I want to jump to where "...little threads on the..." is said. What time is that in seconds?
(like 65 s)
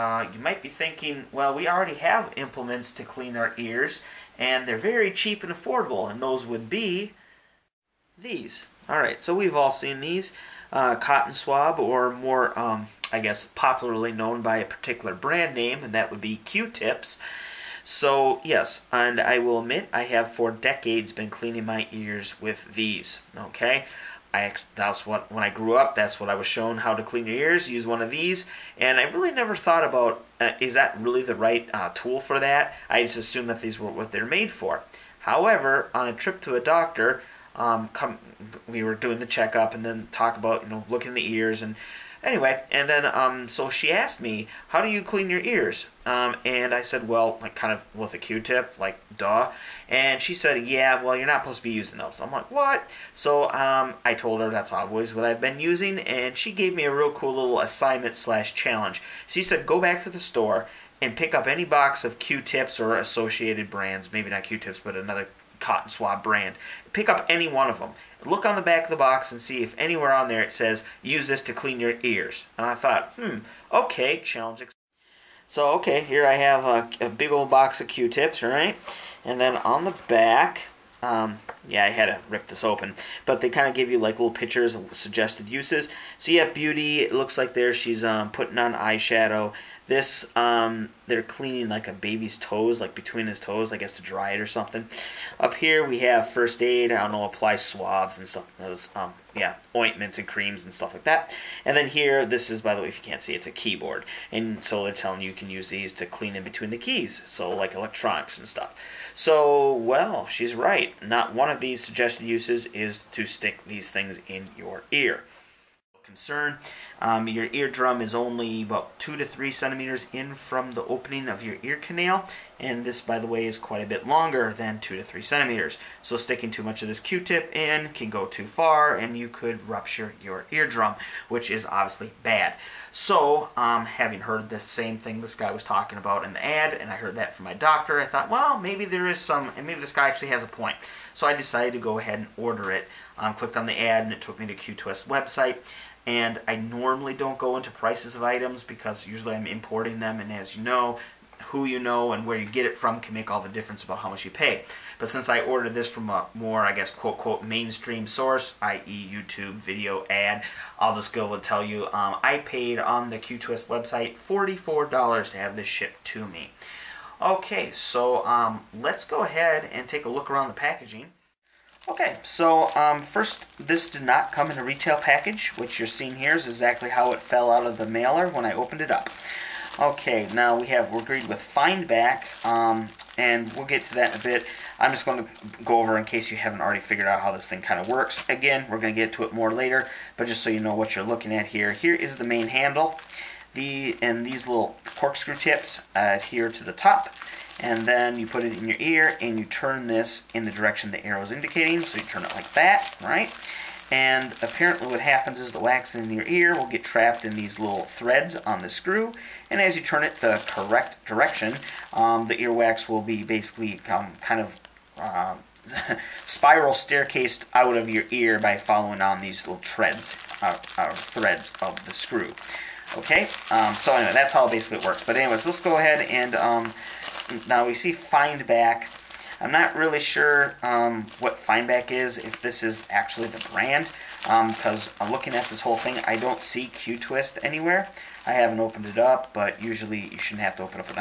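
207 s.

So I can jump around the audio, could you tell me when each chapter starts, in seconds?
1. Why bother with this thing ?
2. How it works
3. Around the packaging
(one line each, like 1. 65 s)
1. 7 s
2. 170 s
3. 221 s.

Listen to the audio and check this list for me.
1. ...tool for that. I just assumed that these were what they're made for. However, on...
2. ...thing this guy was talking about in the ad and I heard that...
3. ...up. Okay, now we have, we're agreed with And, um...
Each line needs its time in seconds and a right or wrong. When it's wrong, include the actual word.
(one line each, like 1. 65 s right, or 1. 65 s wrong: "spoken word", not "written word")
1. 31 s right
2. 134 s right
3. 178 s wrong: "Fineback", not "And".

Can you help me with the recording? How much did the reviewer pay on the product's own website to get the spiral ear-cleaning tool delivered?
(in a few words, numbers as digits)
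$44.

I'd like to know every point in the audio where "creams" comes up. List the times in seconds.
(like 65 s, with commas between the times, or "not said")
100 s.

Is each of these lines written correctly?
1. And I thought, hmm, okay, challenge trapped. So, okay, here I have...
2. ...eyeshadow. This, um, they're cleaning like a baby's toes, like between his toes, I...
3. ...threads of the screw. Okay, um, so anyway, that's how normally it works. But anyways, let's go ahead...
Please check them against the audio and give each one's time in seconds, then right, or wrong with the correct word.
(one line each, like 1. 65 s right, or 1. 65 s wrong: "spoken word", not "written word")
1. 72 s wrong: "accepted", not "trapped"
2. 88 s right
3. 220 s wrong: "basically", not "normally".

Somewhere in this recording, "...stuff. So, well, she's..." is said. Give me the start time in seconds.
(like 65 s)
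108 s.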